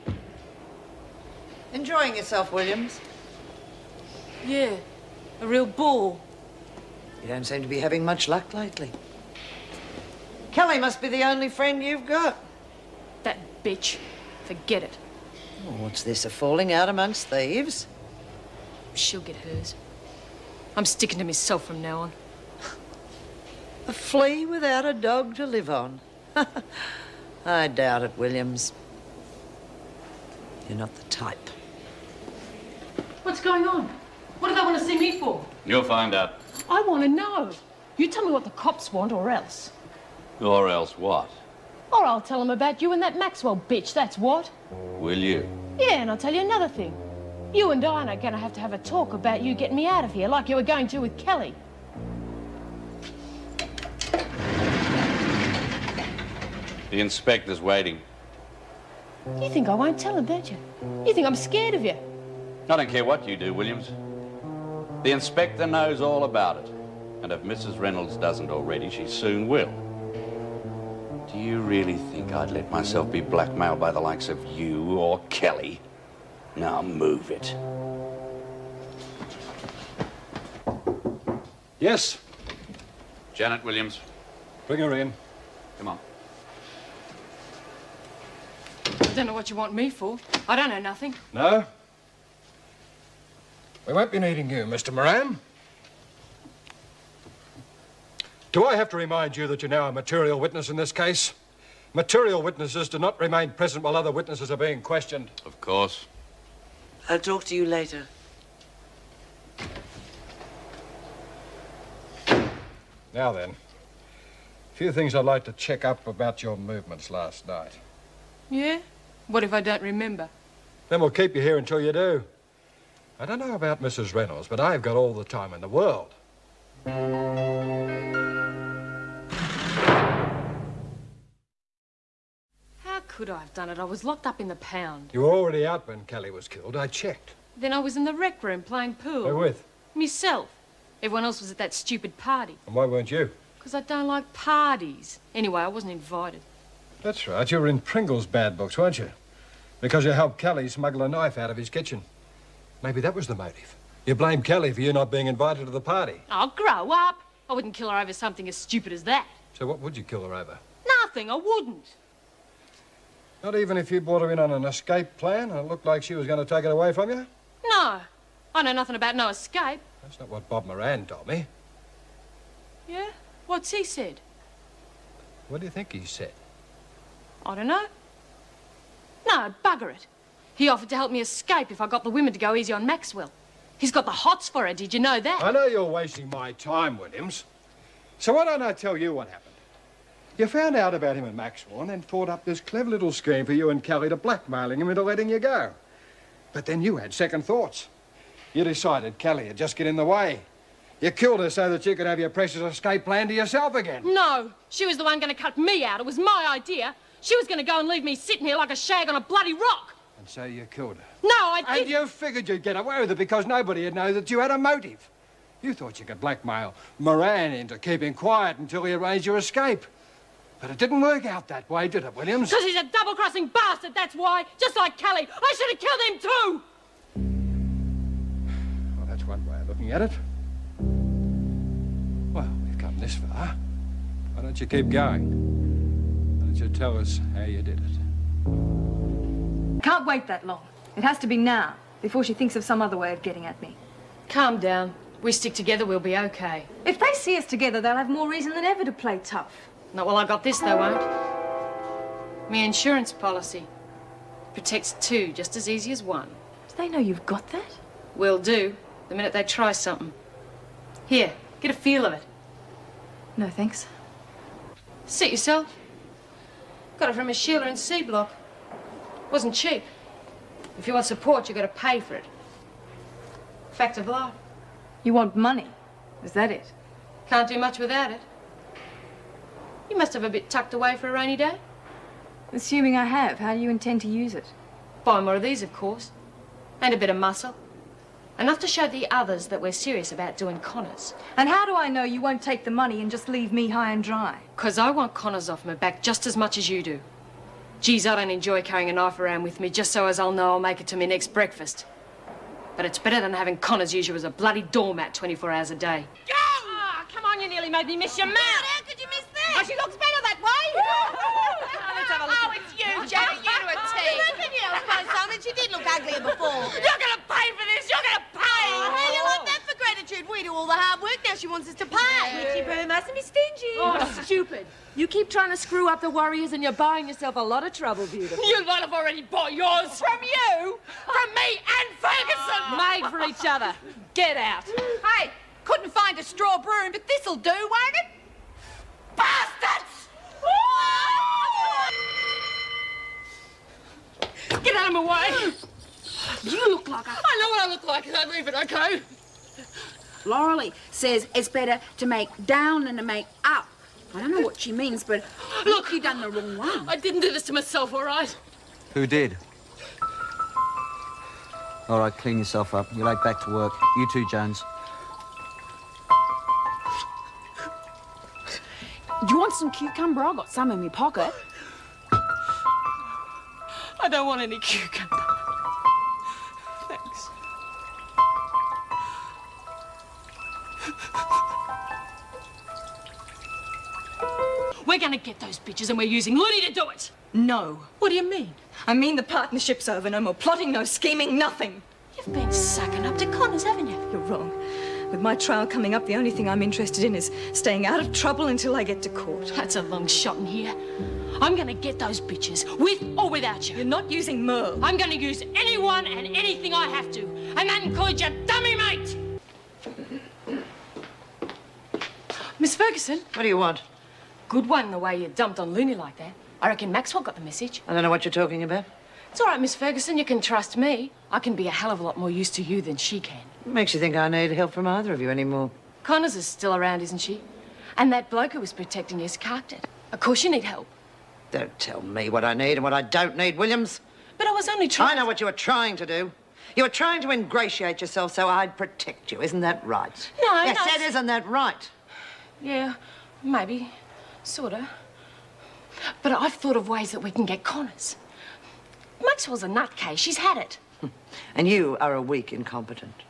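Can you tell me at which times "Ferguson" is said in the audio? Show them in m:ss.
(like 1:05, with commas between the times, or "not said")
5:31, 6:52, 6:59.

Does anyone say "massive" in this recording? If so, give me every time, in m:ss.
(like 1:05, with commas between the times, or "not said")
not said.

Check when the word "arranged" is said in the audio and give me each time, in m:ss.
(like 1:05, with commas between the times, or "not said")
3:38.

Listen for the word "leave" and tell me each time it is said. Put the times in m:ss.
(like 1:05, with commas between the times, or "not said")
3:27, 4:53, 5:48.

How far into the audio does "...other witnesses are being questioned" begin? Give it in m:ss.
1:43.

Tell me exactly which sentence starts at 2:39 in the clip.
So what would you kill her over?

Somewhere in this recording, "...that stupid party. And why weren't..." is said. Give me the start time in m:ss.
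2:21.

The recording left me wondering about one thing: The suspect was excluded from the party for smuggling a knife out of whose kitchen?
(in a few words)
Pringle's.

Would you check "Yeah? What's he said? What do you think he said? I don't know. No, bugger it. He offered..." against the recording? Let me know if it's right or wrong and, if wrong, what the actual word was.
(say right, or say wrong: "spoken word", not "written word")
right.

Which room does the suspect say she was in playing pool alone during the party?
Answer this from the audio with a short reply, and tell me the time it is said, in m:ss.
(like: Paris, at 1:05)
rec room, at 2:18.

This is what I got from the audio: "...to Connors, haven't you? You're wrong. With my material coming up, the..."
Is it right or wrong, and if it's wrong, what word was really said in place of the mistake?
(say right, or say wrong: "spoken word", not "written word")
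wrong: "trial", not "material".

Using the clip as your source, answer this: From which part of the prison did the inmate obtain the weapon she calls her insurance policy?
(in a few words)
C Block.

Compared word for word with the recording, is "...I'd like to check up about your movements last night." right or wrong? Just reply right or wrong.
right.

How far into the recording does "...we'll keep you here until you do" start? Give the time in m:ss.
2:01.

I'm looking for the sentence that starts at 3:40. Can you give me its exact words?
But it didn't work out that way, did it, Williams?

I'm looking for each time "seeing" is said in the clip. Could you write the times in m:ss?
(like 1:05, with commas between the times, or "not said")
not said.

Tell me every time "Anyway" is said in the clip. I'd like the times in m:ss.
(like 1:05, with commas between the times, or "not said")
2:25.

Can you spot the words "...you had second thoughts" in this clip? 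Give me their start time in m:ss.
3:16.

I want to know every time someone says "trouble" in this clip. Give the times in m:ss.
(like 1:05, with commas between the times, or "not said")
5:27, 6:38.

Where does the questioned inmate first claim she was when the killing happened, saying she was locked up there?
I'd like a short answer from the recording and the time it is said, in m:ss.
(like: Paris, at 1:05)
the pound, at 2:14.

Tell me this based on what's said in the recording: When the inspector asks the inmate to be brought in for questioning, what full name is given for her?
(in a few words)
Janet Williams.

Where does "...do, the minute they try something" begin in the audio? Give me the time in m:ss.
4:18.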